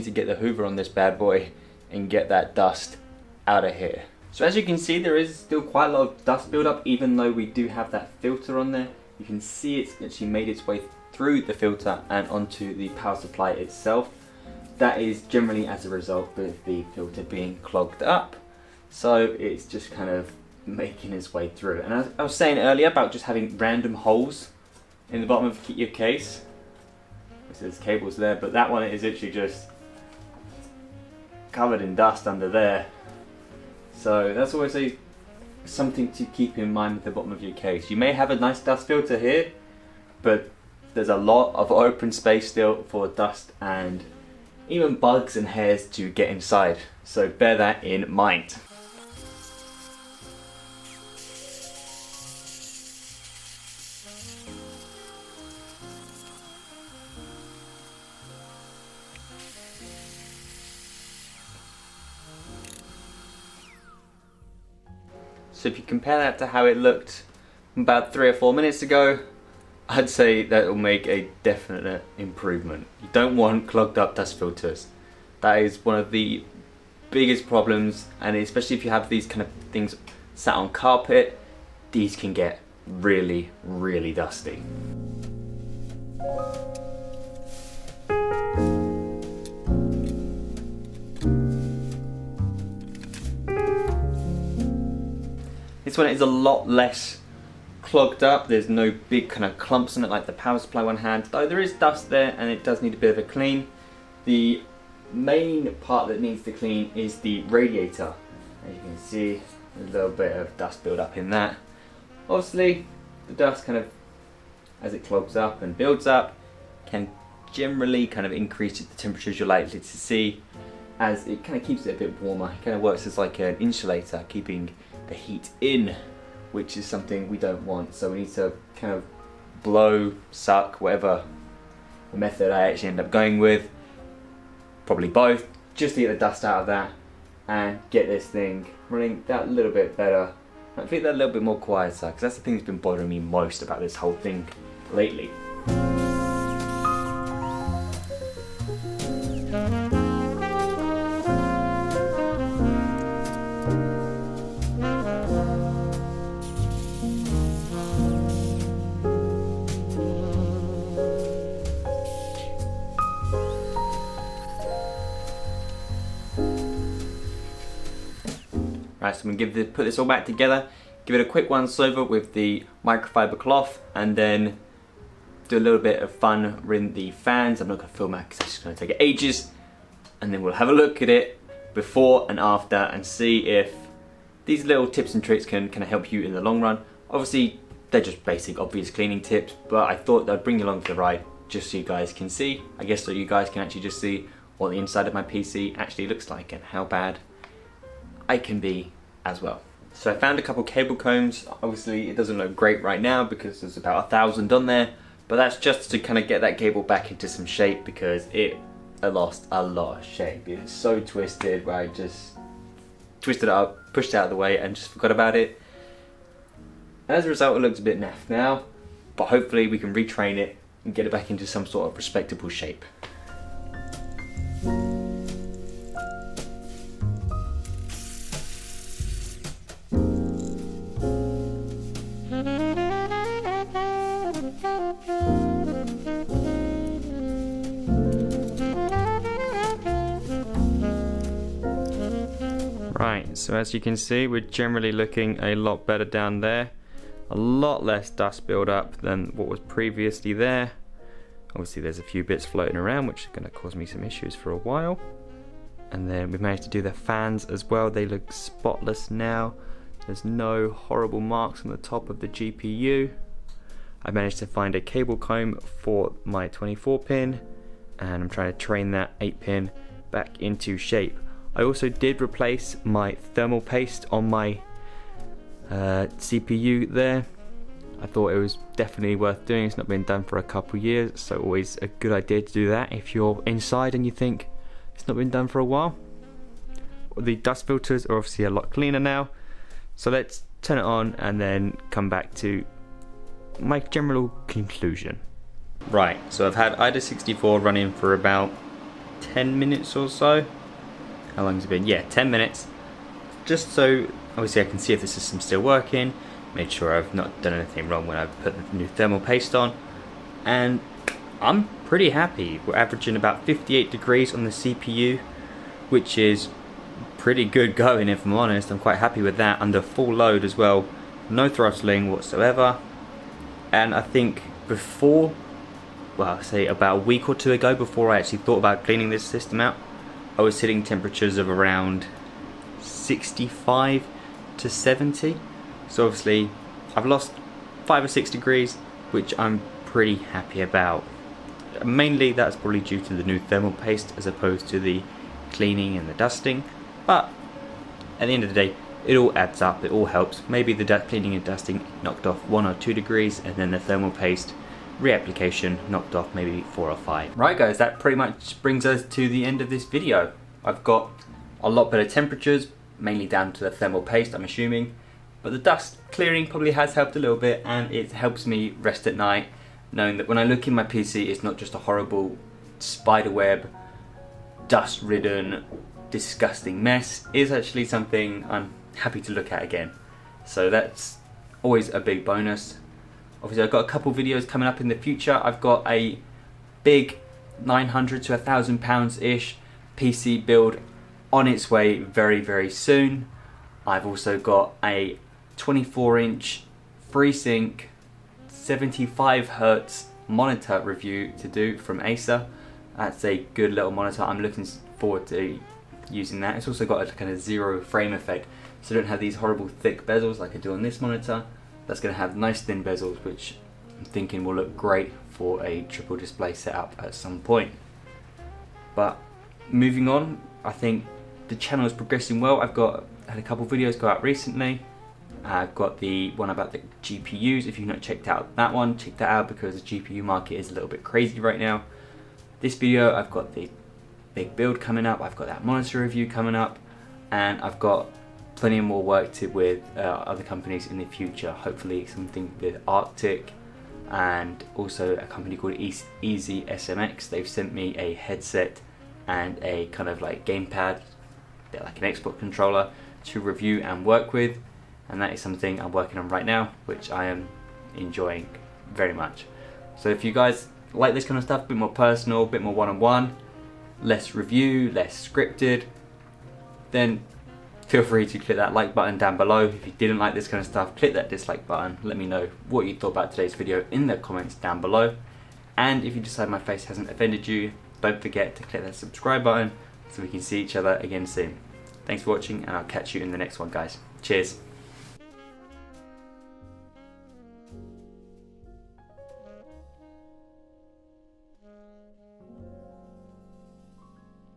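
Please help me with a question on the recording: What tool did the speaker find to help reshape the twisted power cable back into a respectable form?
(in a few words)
Cable combs.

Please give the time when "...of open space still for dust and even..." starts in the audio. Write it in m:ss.
0:41.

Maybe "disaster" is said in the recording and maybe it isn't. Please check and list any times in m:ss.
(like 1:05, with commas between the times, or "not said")
not said.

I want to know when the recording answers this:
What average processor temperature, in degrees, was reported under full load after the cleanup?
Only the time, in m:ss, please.
5:13.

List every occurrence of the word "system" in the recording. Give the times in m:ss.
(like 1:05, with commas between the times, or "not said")
5:05, 5:29.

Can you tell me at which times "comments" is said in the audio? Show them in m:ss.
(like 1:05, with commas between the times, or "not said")
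7:54.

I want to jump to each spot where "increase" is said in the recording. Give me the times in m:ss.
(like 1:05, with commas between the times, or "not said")
1:58.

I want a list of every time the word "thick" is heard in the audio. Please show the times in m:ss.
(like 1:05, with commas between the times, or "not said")
6:49.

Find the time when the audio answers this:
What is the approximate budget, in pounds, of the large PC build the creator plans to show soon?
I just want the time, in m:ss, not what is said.
6:27.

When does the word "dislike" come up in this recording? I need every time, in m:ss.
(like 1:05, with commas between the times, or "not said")
7:51.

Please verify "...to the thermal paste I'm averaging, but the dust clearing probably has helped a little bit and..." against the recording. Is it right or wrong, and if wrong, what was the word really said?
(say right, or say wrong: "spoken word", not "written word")
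wrong: "assuming", not "averaging".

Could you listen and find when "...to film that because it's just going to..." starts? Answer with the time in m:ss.
2:57.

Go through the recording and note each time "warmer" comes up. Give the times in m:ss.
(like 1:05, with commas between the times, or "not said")
2:02.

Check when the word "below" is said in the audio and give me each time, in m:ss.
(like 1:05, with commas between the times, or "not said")
7:49, 7:54.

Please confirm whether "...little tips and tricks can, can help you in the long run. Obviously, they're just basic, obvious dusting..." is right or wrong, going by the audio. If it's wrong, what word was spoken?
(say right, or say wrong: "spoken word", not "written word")
wrong: "cleaning", not "dusting".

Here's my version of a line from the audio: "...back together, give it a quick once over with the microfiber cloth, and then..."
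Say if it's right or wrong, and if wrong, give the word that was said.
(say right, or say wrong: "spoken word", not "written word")
right.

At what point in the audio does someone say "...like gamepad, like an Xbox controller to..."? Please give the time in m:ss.
7:30.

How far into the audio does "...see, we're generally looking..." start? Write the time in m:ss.
4:03.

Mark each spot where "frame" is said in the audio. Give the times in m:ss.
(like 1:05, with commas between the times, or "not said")
6:47.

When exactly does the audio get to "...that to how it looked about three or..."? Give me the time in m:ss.
1:06.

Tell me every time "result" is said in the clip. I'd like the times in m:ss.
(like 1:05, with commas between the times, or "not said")
0:15, 3:37.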